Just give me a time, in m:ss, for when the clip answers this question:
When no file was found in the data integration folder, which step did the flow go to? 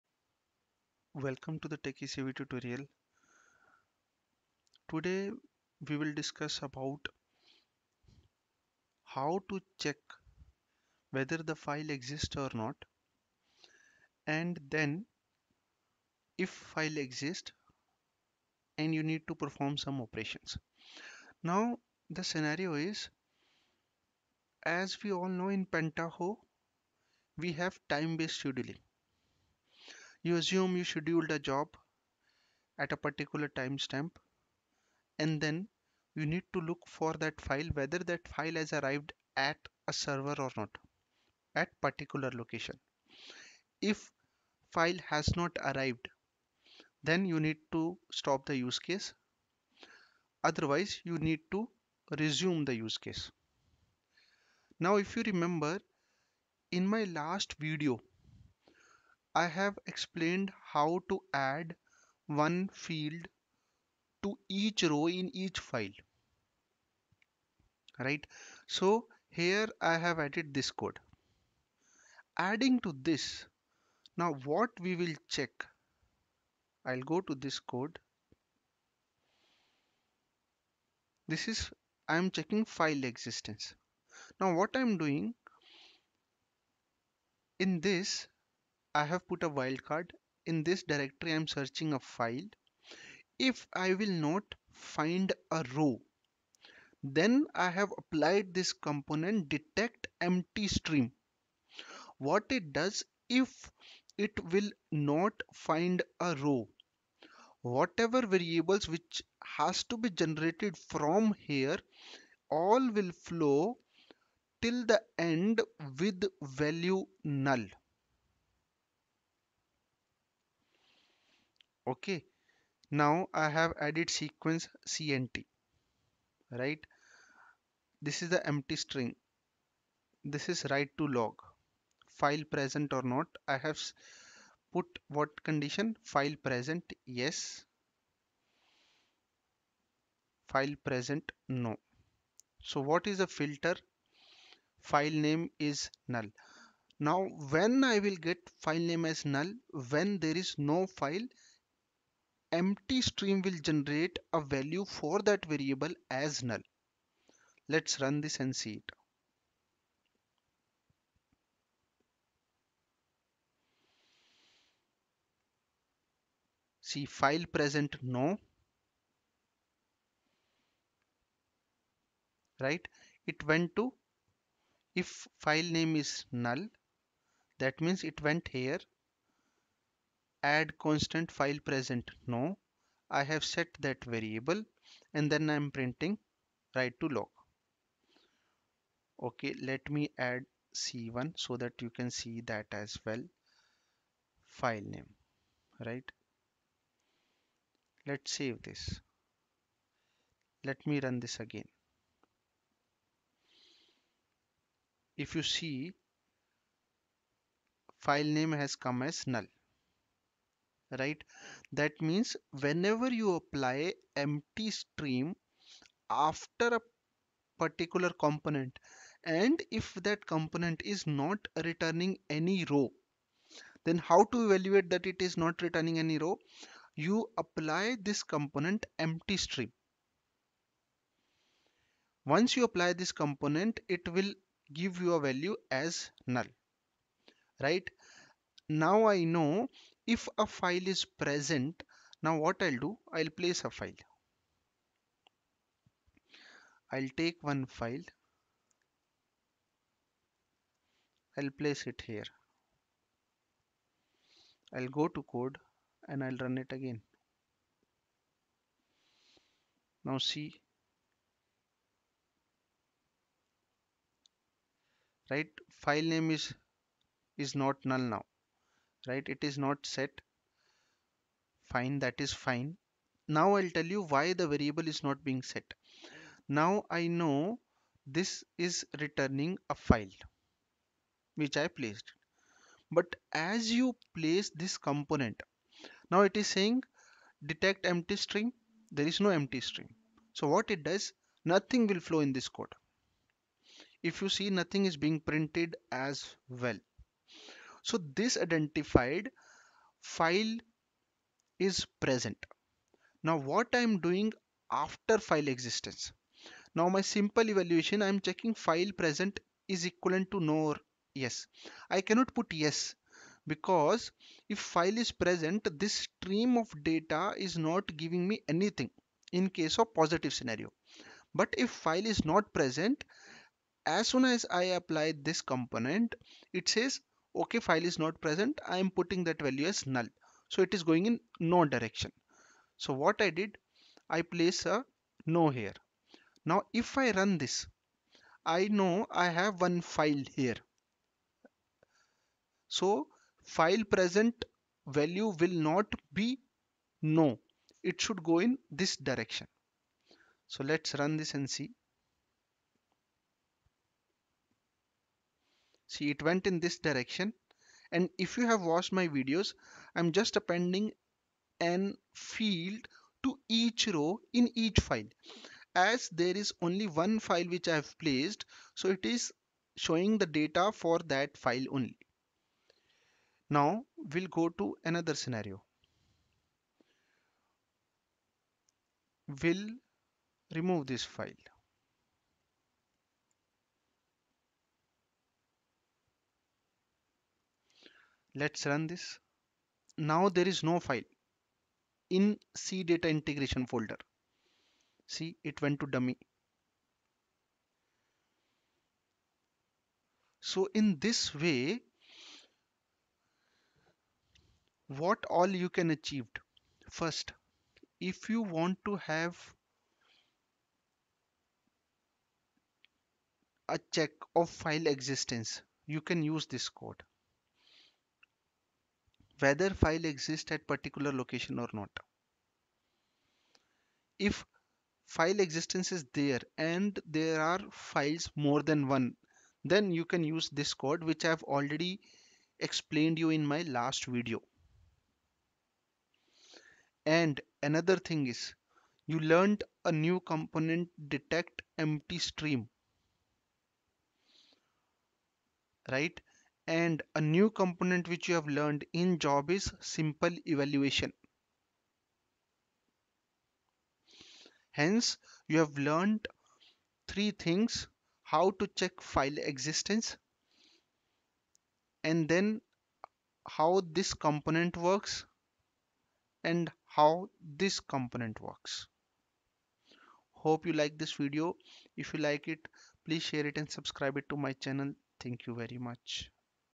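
6:35.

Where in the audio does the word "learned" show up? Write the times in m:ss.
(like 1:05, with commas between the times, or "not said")
7:19, 7:28, 7:35.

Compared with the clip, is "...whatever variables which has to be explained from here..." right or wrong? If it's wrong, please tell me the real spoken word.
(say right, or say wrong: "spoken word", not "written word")
wrong: "generated", not "explained".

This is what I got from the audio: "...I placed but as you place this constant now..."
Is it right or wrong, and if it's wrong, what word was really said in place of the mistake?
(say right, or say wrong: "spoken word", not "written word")
wrong: "component", not "constant".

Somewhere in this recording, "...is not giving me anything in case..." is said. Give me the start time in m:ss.
5:17.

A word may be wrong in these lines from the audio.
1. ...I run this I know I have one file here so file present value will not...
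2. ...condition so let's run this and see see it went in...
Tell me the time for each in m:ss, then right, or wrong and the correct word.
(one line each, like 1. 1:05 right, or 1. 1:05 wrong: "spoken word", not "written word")
1. 5:36 right
2. 5:48 wrong: "direction", not "condition".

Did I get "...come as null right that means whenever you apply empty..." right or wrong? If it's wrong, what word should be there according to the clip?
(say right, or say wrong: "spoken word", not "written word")
right.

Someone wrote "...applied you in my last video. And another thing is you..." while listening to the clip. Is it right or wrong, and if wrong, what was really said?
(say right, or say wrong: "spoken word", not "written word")
wrong: "explained", not "applied".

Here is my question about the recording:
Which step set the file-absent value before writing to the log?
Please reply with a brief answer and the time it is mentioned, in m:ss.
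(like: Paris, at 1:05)
Add constant, at 3:00.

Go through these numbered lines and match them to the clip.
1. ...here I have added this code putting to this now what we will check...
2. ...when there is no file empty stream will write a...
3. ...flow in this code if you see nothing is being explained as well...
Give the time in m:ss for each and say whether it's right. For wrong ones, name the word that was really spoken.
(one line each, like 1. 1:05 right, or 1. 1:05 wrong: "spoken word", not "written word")
1. 1:09 wrong: "adding", not "putting"
2. 2:29 wrong: "generate", not "write"
3. 4:51 wrong: "printed", not "explained".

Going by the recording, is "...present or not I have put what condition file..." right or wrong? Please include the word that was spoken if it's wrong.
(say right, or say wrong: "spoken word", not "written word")
right.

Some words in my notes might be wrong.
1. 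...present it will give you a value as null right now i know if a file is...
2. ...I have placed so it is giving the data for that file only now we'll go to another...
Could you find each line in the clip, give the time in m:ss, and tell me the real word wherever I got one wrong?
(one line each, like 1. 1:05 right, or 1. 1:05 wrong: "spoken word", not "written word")
1. 3:53 wrong: "component", not "present"
2. 6:07 wrong: "showing", not "giving".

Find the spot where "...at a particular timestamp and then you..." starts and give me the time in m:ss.
0:32.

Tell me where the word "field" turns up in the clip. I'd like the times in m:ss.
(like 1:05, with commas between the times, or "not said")
1:02, 6:02.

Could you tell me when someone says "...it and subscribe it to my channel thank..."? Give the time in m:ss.
7:53.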